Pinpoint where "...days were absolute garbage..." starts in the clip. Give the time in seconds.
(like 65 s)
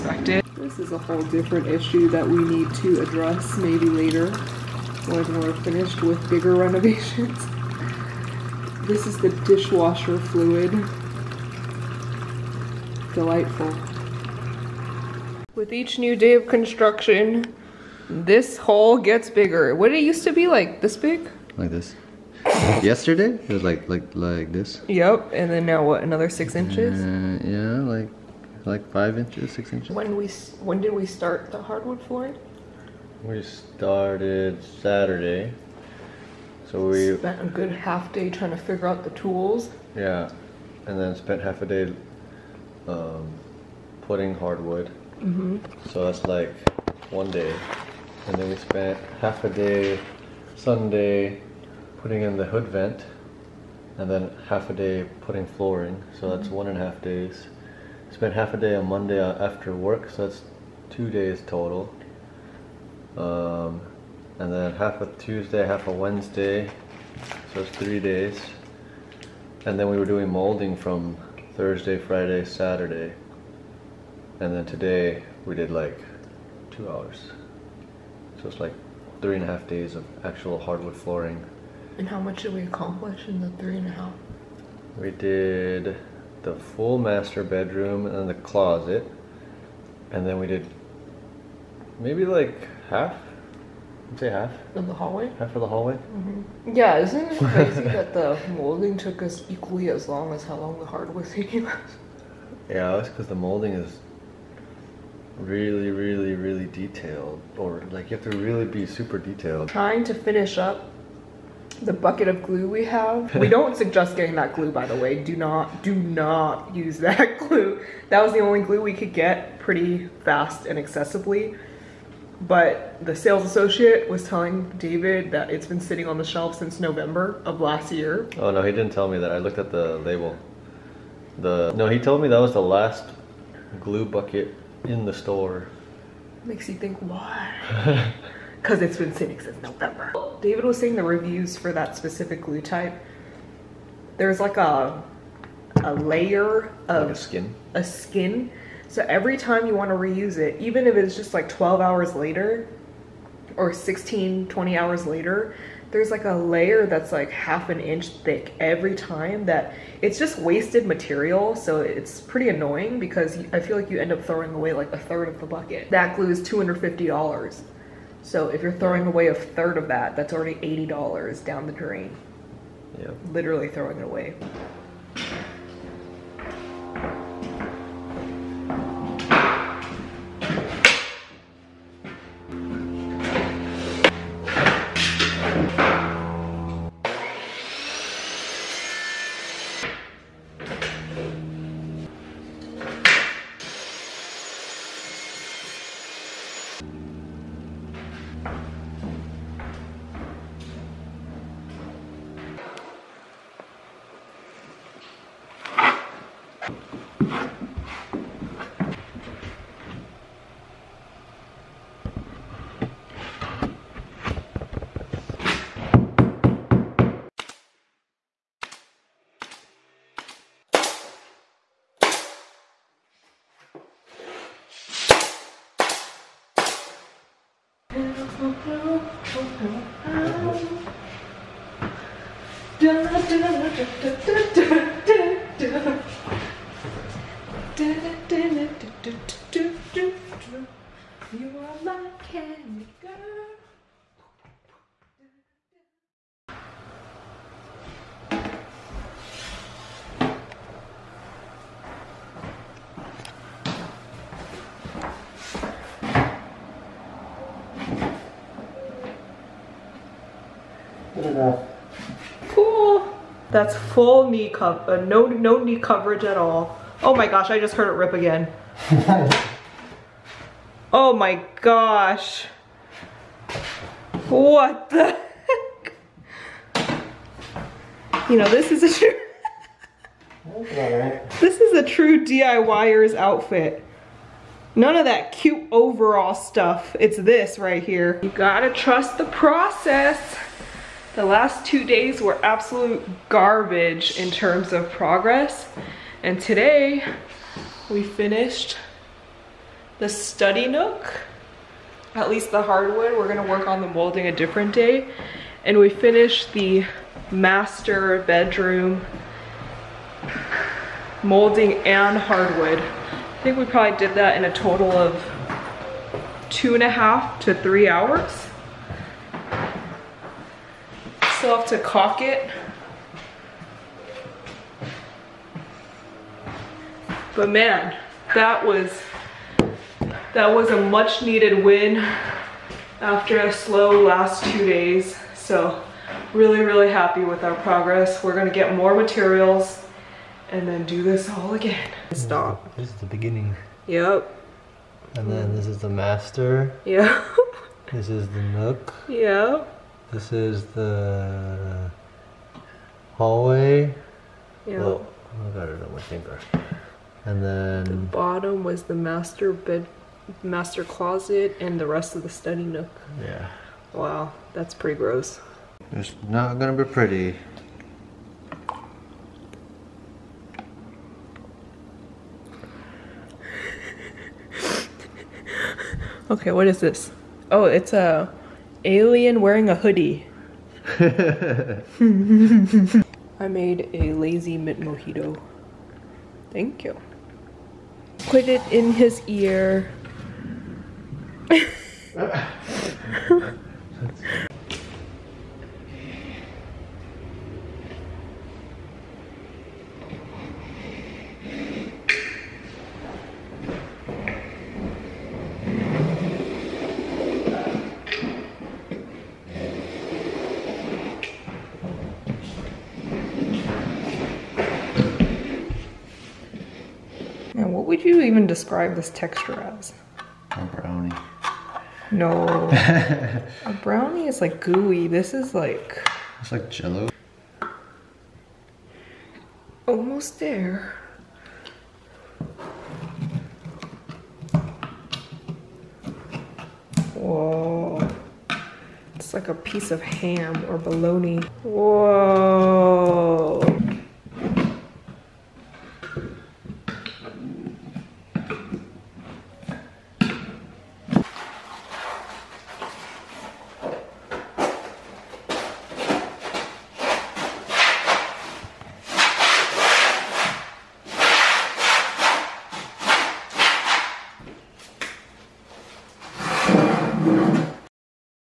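291 s.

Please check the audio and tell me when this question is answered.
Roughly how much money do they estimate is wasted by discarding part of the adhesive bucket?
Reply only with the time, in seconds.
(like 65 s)
170 s.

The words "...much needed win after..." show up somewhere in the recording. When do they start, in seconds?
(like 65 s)
330 s.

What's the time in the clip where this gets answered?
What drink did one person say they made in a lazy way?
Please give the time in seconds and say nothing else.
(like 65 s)
384 s.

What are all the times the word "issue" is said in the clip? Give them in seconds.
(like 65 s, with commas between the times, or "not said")
1 s.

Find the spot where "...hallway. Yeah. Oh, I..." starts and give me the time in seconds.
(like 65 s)
353 s.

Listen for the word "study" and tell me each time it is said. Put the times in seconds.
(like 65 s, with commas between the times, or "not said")
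300 s, 362 s.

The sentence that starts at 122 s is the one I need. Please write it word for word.
But the sales associate was telling David that it's been sitting on the shelf since November of last year.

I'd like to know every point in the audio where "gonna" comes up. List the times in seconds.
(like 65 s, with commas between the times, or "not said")
303 s, 338 s, 366 s.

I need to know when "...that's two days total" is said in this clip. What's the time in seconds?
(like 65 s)
60 s.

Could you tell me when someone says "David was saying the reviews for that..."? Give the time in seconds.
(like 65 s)
140 s.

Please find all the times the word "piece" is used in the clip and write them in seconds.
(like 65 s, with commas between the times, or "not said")
439 s.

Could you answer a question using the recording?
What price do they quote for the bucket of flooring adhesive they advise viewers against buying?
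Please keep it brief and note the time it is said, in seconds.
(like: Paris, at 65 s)
$250, at 165 s.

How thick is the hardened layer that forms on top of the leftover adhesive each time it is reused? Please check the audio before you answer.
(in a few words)
half an inch.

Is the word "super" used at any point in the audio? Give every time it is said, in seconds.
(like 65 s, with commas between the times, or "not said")
108 s.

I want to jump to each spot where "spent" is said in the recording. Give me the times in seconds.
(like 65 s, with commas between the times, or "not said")
37 s, 41 s, 48 s, 58 s.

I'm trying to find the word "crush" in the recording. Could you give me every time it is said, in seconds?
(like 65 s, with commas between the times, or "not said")
not said.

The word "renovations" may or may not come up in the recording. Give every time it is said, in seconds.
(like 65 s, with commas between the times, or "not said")
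6 s.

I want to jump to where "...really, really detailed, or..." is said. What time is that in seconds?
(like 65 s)
105 s.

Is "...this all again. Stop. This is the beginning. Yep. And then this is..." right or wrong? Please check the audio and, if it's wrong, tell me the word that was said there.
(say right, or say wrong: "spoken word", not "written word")
right.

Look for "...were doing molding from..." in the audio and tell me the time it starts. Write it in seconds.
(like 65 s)
69 s.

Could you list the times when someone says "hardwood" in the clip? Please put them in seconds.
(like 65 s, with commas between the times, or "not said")
31 s, 44 s, 80 s, 100 s, 302 s, 312 s.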